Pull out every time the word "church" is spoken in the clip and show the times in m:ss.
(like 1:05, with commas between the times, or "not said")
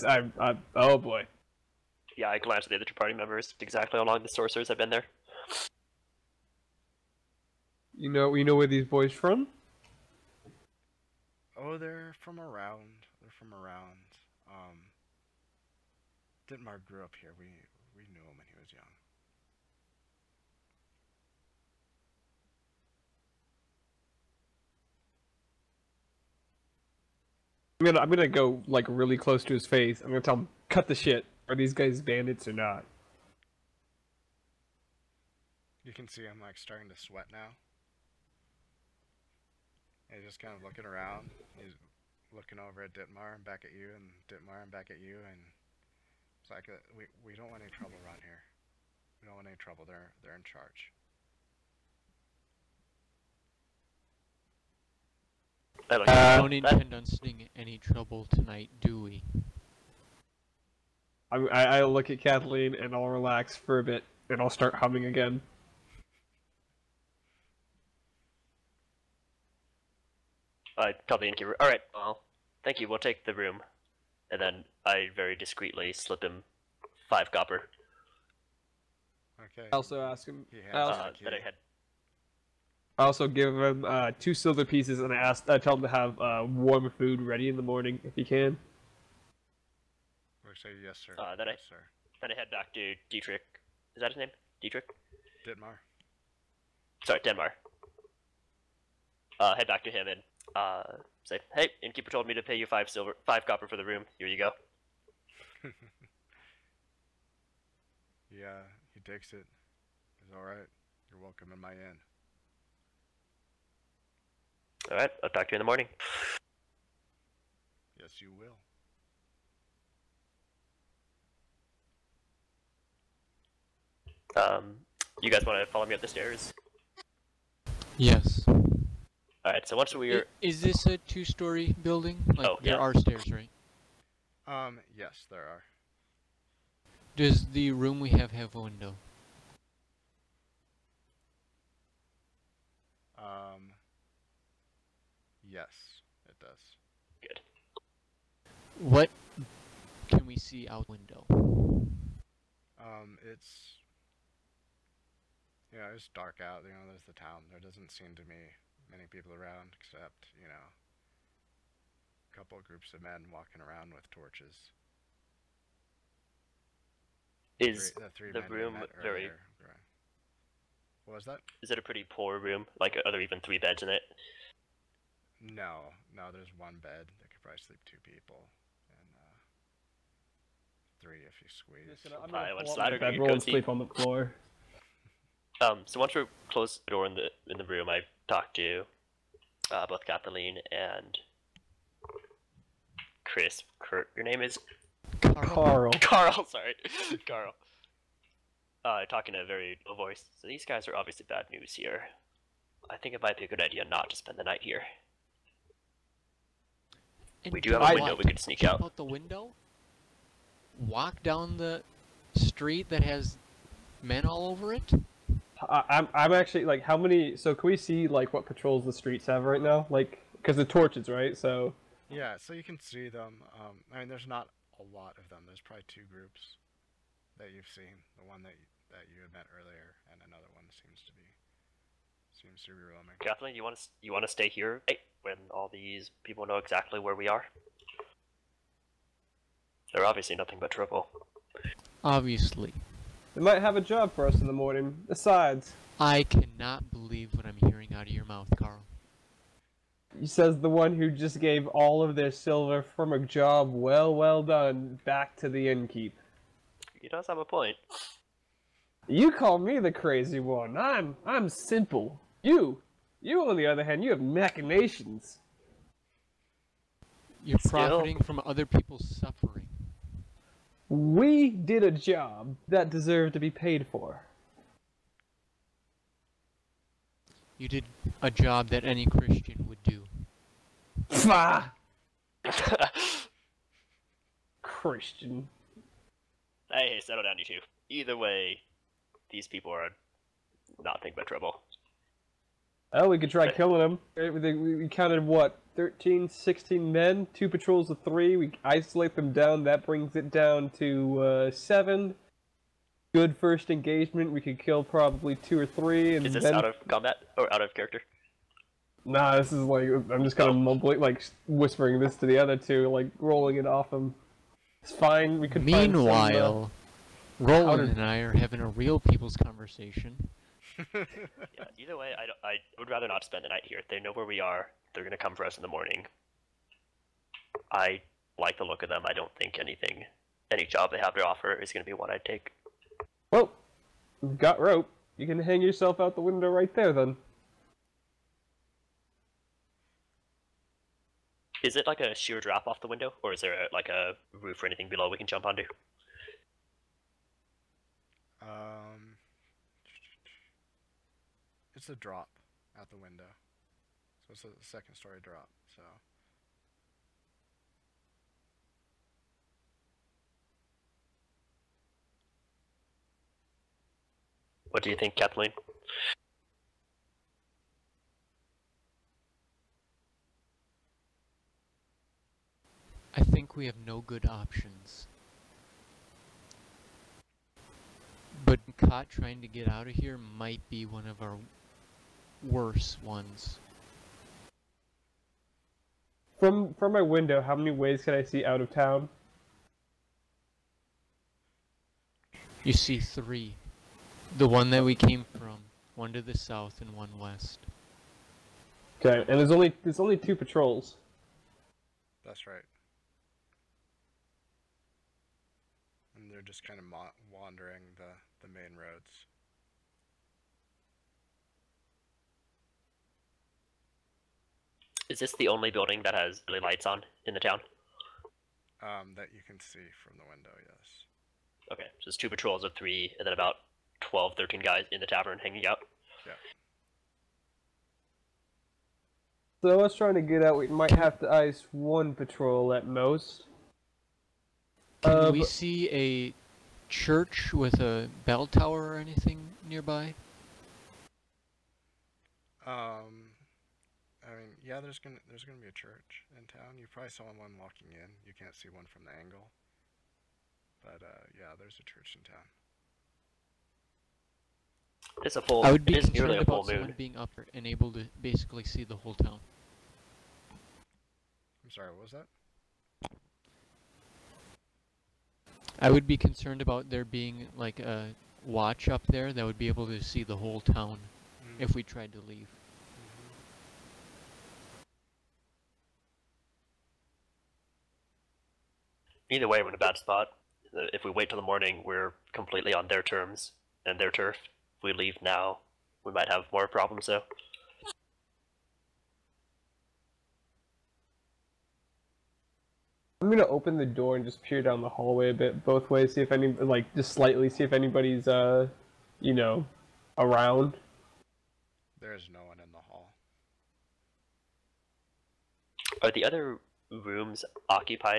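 7:16, 7:25, 7:31.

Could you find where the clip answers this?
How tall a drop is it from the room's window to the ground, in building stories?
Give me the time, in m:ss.
5:54.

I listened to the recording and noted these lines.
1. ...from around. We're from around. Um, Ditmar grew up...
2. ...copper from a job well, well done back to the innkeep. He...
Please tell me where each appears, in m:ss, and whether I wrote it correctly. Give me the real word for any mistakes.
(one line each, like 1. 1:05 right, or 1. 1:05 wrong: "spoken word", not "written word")
1. 0:12 right
2. 4:12 wrong: "silver", not "copper".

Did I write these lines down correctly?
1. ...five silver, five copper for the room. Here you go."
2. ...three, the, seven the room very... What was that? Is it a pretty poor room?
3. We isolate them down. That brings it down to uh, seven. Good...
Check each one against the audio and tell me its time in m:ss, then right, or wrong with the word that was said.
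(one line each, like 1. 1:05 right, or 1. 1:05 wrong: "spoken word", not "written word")
1. 1:42 right
2. 2:48 wrong: "three", not "seven"
3. 4:58 right.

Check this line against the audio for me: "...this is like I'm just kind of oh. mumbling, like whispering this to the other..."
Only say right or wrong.
right.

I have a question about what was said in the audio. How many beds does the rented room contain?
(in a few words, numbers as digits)
1.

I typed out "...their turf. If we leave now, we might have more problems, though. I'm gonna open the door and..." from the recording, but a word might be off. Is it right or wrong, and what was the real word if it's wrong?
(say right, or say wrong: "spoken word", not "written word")
right.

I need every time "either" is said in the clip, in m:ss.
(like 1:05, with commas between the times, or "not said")
4:47, 5:21, 7:59.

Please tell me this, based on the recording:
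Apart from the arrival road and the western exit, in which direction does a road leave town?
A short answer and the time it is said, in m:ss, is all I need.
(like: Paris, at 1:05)
South, at 6:35.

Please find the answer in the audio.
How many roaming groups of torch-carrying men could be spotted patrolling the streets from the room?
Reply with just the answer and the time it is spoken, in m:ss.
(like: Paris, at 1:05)
2, at 3:45.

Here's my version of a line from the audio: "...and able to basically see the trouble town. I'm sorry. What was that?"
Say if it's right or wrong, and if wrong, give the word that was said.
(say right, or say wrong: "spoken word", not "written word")
wrong: "whole", not "trouble".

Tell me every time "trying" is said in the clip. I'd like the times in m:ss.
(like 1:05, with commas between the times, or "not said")
6:19, 7:09.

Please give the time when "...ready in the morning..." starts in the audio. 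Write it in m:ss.
1:27.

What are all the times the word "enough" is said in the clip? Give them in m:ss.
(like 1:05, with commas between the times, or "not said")
not said.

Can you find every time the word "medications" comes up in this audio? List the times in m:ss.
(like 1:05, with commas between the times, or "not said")
not said.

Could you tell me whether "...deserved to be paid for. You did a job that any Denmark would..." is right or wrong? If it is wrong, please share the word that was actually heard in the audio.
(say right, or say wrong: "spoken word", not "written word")
wrong: "Christian", not "Denmark".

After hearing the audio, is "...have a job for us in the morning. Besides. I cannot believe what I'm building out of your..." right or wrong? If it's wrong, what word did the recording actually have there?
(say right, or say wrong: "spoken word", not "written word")
wrong: "hearing", not "building".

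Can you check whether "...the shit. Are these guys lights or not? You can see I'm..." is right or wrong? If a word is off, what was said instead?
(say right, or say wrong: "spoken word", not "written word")
wrong: "bandits", not "lights".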